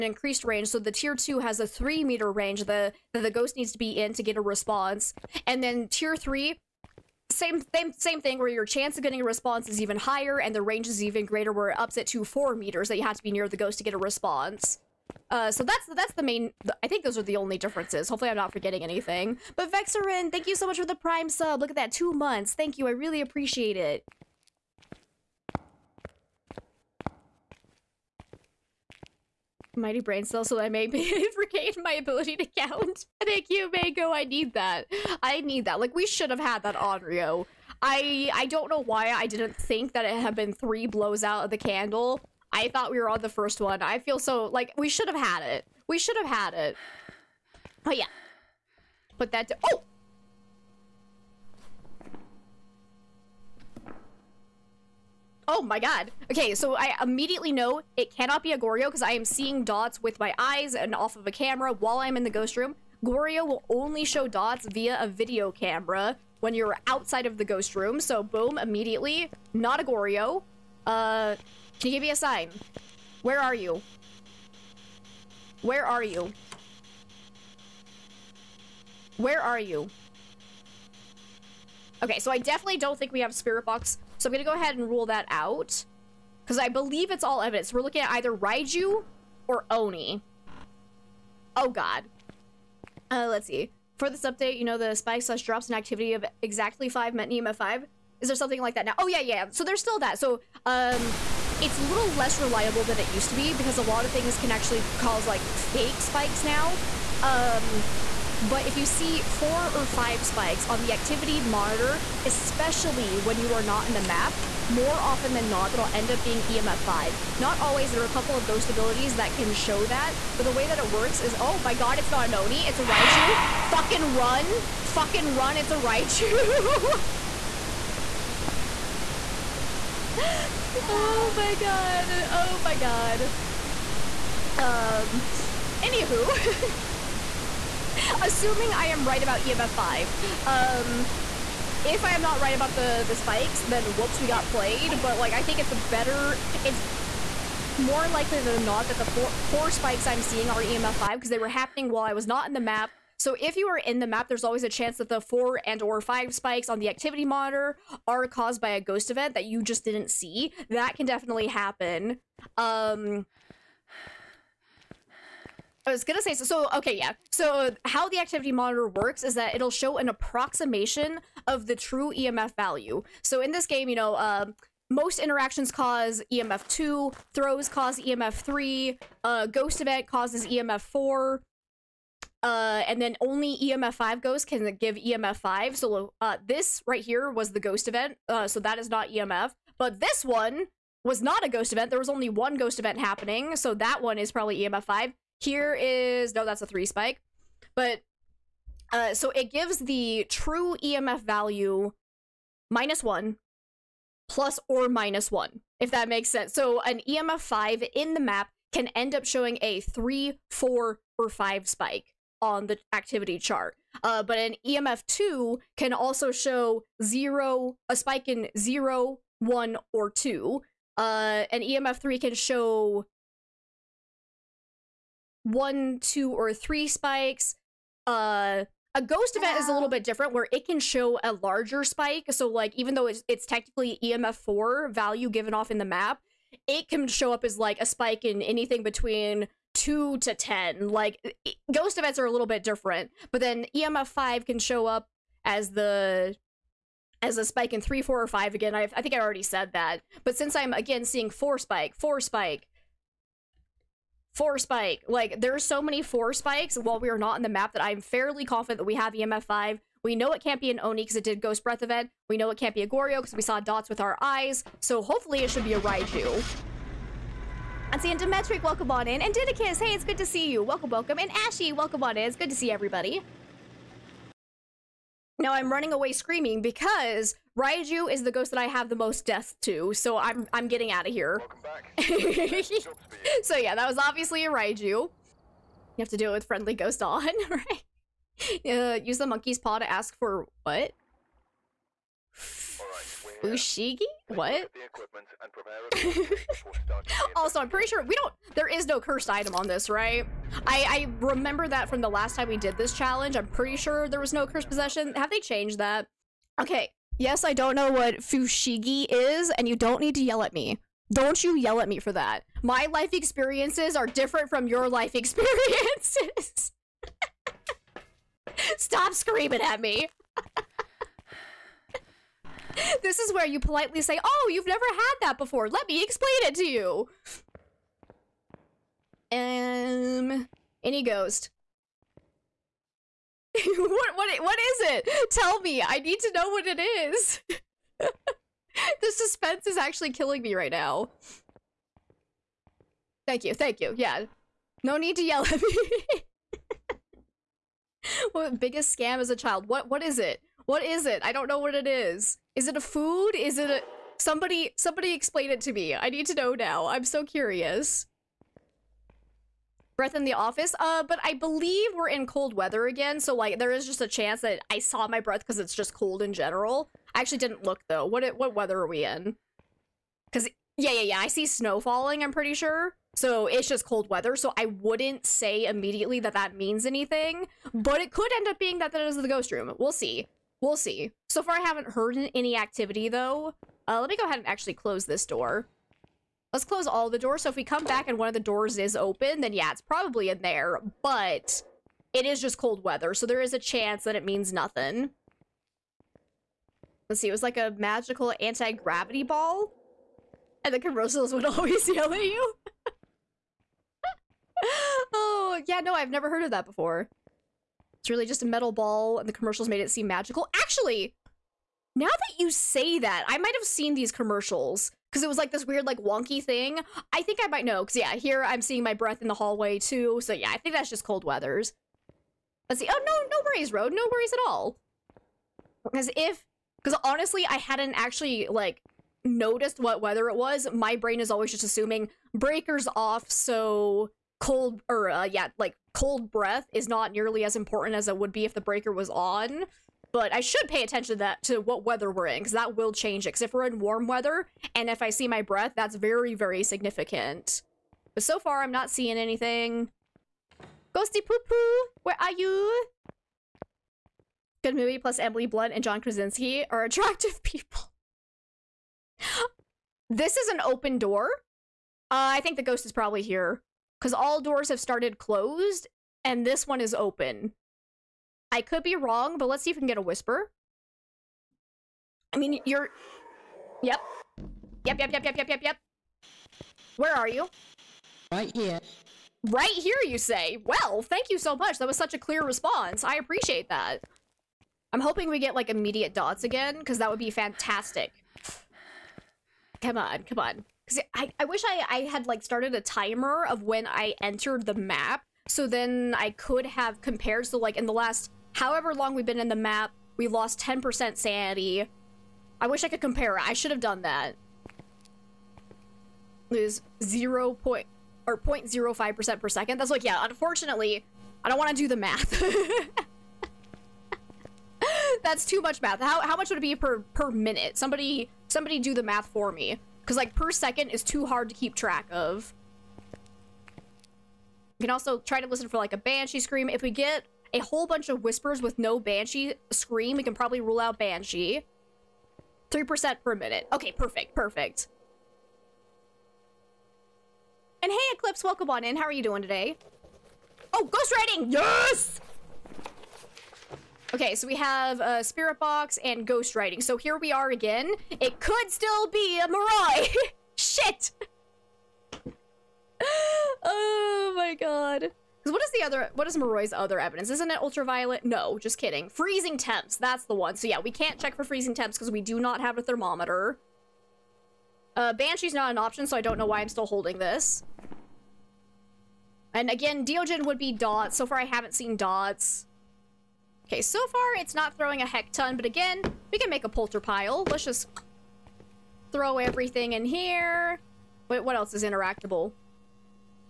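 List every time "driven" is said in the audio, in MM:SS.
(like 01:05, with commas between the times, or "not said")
not said.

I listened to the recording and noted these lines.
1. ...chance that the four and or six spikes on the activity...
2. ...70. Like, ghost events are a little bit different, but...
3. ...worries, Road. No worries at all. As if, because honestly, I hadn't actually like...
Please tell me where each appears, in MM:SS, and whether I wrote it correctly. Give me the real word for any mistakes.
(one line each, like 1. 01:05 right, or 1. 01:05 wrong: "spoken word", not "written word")
1. 02:34 wrong: "five", not "six"
2. 04:00 wrong: "10", not "70"
3. 07:03 right.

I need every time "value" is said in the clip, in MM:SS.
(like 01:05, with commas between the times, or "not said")
02:52, 03:21, 03:54.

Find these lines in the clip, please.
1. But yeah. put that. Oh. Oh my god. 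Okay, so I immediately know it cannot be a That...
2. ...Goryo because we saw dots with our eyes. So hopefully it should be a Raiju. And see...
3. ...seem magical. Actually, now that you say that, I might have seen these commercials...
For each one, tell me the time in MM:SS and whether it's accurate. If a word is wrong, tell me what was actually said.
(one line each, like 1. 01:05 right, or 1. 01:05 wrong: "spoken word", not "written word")
1. 00:47 wrong: "Goryo", not "That"
2. 04:22 right
3. 06:49 right.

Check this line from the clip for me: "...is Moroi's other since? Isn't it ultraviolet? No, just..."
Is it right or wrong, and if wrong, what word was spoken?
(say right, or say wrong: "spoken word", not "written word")
wrong: "evidence", not "since".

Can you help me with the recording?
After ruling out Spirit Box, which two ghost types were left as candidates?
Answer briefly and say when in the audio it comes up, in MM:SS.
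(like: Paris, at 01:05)
Raiju or Oni, at 01:28.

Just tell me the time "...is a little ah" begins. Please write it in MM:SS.
03:49.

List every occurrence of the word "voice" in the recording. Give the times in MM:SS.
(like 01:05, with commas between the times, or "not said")
not said.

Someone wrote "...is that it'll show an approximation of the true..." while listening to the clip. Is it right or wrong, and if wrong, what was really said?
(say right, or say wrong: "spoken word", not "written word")
right.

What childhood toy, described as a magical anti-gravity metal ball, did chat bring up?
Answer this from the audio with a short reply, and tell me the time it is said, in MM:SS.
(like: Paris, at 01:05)
Fushigi, at 05:08.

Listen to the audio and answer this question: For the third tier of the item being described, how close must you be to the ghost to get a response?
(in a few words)
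4 meters.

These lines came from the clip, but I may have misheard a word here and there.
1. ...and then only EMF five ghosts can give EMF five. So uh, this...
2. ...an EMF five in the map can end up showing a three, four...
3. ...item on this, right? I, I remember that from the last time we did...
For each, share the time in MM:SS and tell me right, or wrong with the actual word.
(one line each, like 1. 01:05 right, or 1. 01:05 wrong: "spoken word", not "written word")
1. 03:02 right
2. 03:26 right
3. 04:59 right.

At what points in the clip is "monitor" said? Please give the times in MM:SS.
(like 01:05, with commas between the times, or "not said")
01:51, 02:37, 02:48.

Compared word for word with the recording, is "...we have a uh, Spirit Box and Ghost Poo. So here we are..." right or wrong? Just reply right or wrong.
wrong.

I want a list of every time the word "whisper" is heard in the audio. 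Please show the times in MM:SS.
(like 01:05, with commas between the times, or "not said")
07:50, 08:48.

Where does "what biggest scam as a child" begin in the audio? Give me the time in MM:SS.
05:48.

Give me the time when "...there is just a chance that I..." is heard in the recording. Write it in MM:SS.
06:03.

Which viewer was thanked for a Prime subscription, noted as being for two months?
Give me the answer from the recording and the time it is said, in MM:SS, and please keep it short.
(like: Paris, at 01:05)
Vexarin, at 00:19.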